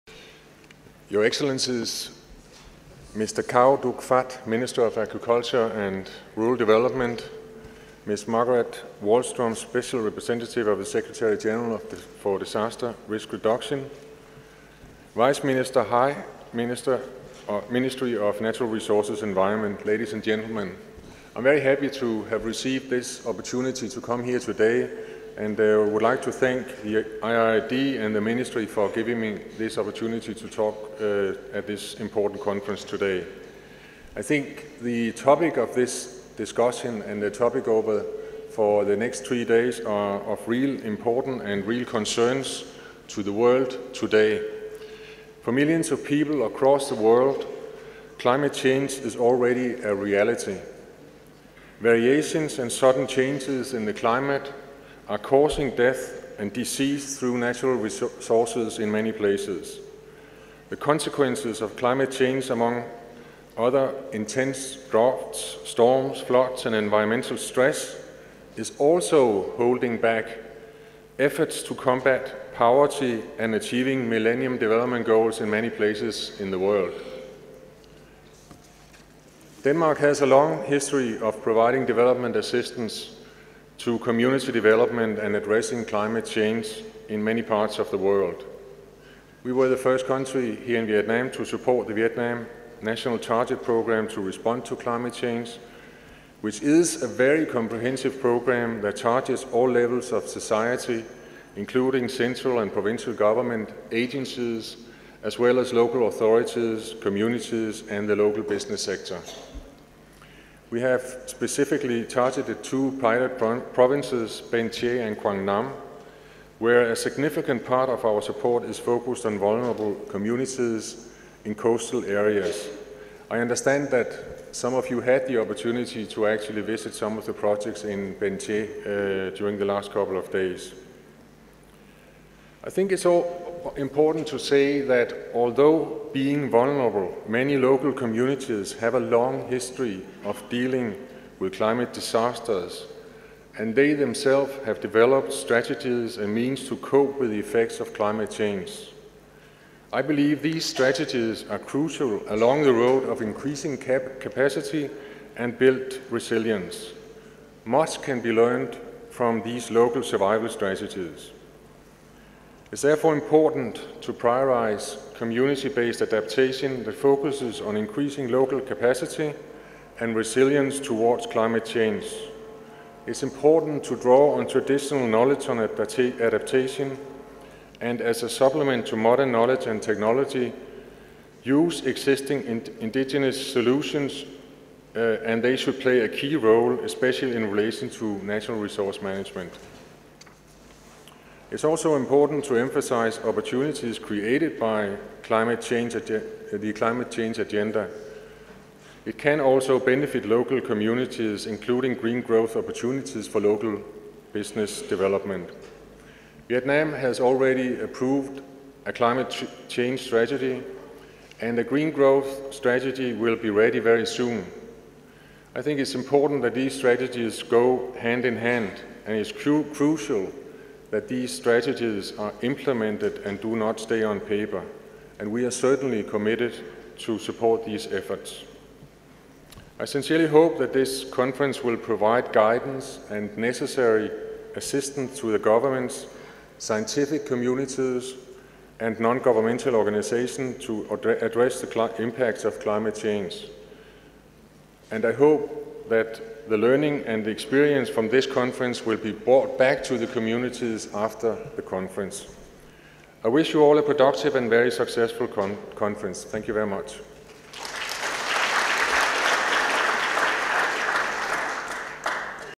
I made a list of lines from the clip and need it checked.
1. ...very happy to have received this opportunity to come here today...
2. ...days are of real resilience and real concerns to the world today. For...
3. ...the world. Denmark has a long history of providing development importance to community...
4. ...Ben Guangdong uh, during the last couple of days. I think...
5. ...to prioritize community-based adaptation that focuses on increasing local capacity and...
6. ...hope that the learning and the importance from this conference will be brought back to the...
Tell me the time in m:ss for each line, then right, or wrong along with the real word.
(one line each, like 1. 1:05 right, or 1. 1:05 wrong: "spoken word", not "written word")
1. 0:21 right
2. 0:39 wrong: "importance", not "resilience"
3. 1:16 wrong: "assistance", not "importance"
4. 2:08 wrong: "Tre", not "Guangdong"
5. 2:44 right
6. 4:05 wrong: "experience", not "importance".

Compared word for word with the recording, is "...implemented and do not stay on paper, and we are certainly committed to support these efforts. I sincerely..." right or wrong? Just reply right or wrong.
right.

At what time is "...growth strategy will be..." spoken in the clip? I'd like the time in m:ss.
3:31.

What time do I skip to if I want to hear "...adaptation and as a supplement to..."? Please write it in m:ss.
2:55.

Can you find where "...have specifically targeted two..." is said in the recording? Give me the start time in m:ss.
1:50.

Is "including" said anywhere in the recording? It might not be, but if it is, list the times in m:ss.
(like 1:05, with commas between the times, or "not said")
1:41, 3:21.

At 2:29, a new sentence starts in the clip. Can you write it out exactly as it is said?
I believe these strategies are crucial along the road of increasing cap capacity and built resilience.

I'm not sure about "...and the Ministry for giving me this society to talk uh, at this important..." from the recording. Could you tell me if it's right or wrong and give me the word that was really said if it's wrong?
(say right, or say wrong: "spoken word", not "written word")
wrong: "opportunity", not "society".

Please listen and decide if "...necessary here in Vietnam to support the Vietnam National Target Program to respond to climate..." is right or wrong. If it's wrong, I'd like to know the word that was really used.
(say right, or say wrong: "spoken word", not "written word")
wrong: "country", not "necessary".